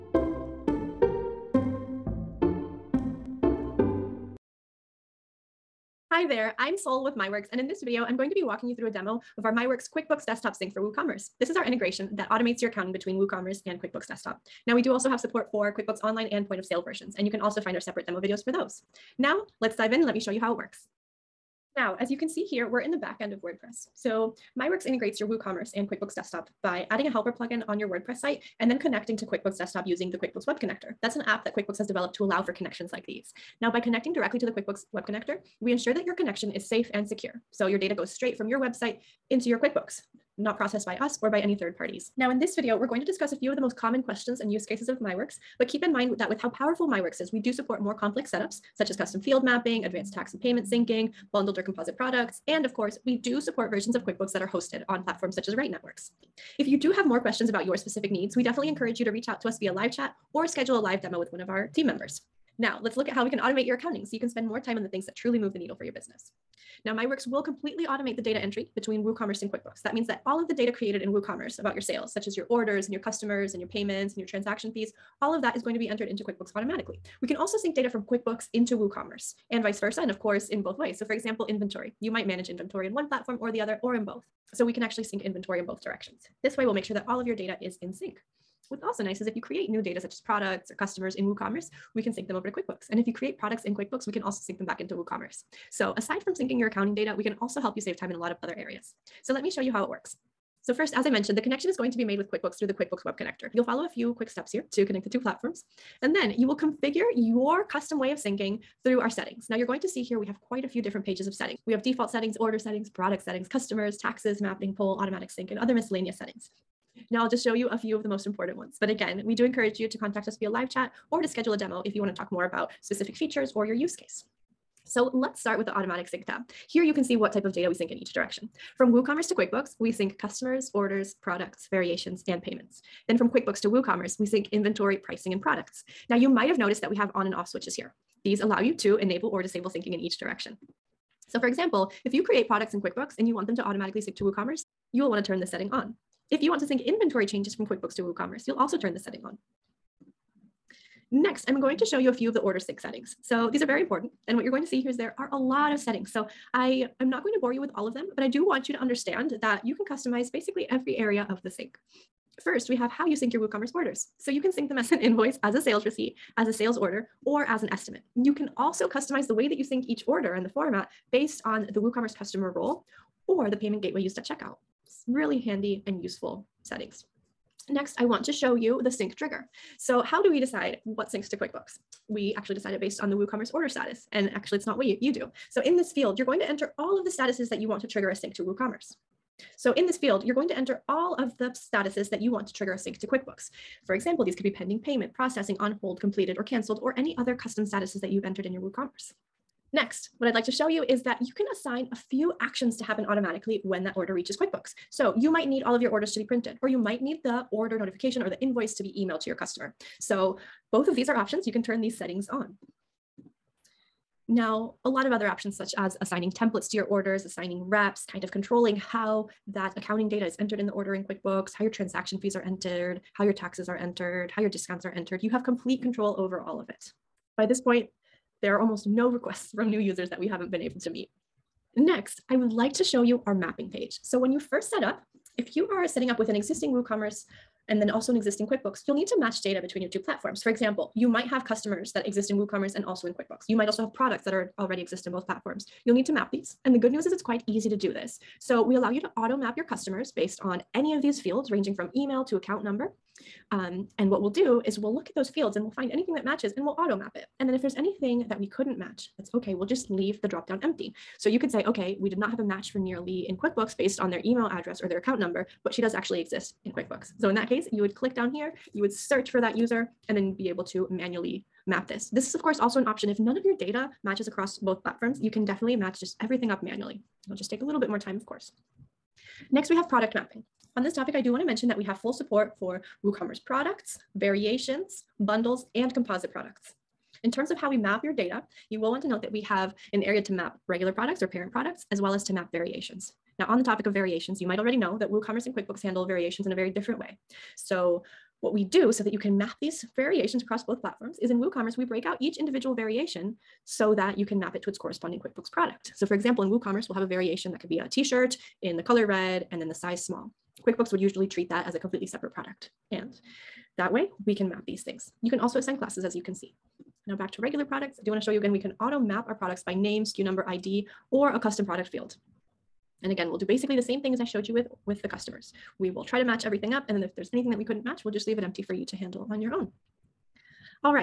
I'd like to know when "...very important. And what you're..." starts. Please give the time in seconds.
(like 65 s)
153 s.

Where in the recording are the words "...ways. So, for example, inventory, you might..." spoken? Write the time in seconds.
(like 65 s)
80 s.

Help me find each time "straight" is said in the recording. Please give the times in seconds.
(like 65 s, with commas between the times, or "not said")
38 s.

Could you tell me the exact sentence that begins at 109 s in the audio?
Now you're going to see here we have quite a few different pages of settings.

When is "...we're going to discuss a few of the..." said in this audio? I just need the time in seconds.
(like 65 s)
42 s.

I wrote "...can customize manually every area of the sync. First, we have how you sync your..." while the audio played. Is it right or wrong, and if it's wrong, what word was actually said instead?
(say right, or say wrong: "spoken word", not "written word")
wrong: "basically", not "manually".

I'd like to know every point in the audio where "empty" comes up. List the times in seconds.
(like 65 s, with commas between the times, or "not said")
260 s, 328 s.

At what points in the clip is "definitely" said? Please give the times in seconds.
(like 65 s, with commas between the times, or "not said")
58 s, 275 s.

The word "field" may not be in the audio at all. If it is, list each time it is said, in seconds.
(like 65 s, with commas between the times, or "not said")
49 s, 185 s, 189 s, 251 s, 255 s, 321 s.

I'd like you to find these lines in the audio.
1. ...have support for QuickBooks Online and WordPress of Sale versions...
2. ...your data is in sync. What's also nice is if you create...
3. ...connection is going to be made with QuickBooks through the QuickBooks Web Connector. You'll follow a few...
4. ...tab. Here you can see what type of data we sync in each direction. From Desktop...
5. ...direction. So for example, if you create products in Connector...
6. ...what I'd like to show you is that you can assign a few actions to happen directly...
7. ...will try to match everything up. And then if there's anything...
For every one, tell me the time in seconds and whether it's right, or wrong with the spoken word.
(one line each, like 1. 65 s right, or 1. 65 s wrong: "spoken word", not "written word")
1. 15 s wrong: "Point", not "WordPress"
2. 87 s right
3. 101 s right
4. 126 s wrong: "WooCommerce", not "Desktop"
5. 140 s wrong: "QuickBooks", not "Connector"
6. 200 s wrong: "automatically", not "directly"
7. 325 s right.